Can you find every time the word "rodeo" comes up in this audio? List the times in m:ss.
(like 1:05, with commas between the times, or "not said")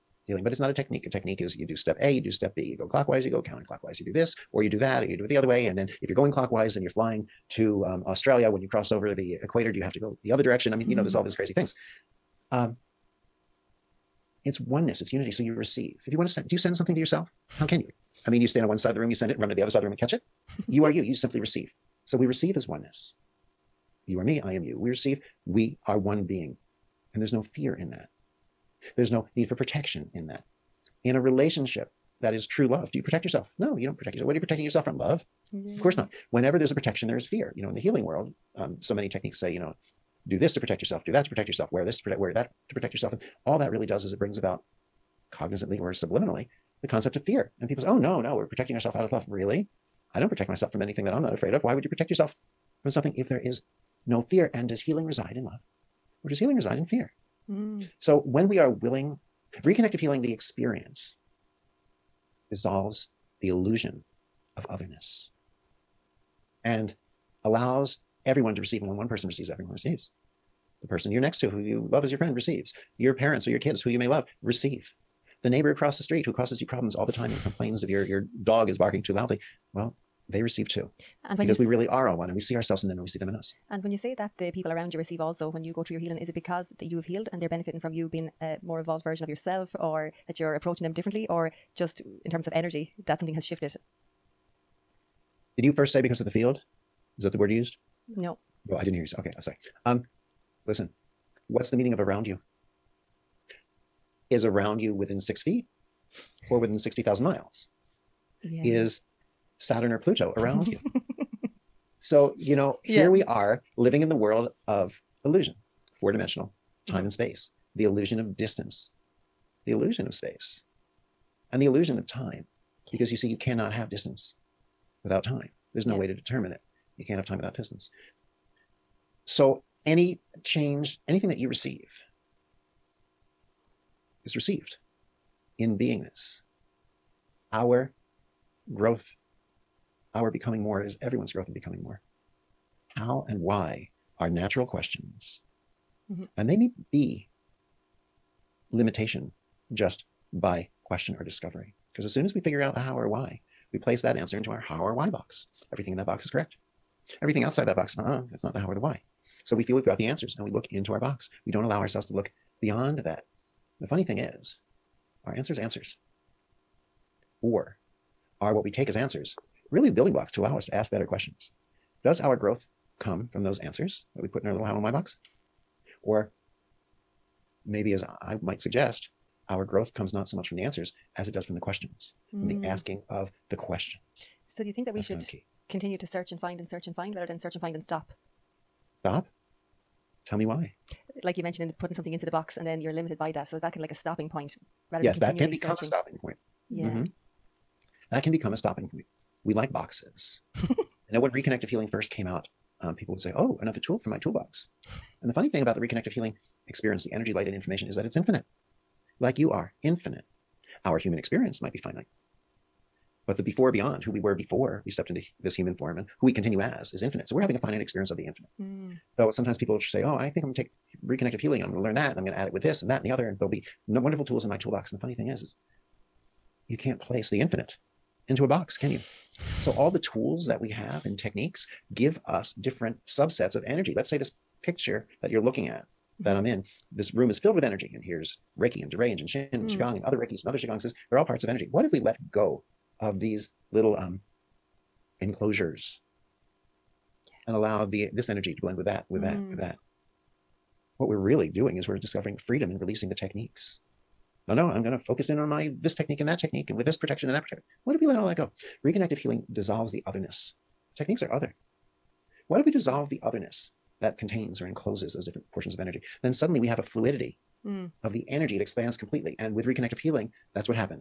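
not said.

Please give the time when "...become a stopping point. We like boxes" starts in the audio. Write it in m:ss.
3:18.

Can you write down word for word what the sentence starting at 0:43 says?
And all that really does is it brings about cognizantly or subliminally the concept of fear.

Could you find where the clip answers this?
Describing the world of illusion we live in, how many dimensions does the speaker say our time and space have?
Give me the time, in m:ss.
1:56.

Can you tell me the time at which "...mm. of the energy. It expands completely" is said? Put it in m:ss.
4:27.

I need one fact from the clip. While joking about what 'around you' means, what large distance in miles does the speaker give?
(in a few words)
60,000 miles.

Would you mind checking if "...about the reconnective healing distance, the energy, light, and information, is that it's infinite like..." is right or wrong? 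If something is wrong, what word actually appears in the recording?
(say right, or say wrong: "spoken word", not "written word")
wrong: "experience", not "distance".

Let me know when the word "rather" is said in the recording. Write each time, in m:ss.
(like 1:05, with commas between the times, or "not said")
3:07, 3:14.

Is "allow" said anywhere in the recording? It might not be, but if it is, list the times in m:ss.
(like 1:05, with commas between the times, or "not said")
1:07, 2:41, 2:50, 4:07.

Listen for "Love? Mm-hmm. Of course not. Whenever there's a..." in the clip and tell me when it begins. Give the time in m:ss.
0:34.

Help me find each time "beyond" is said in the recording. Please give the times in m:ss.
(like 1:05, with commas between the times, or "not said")
2:42, 3:33.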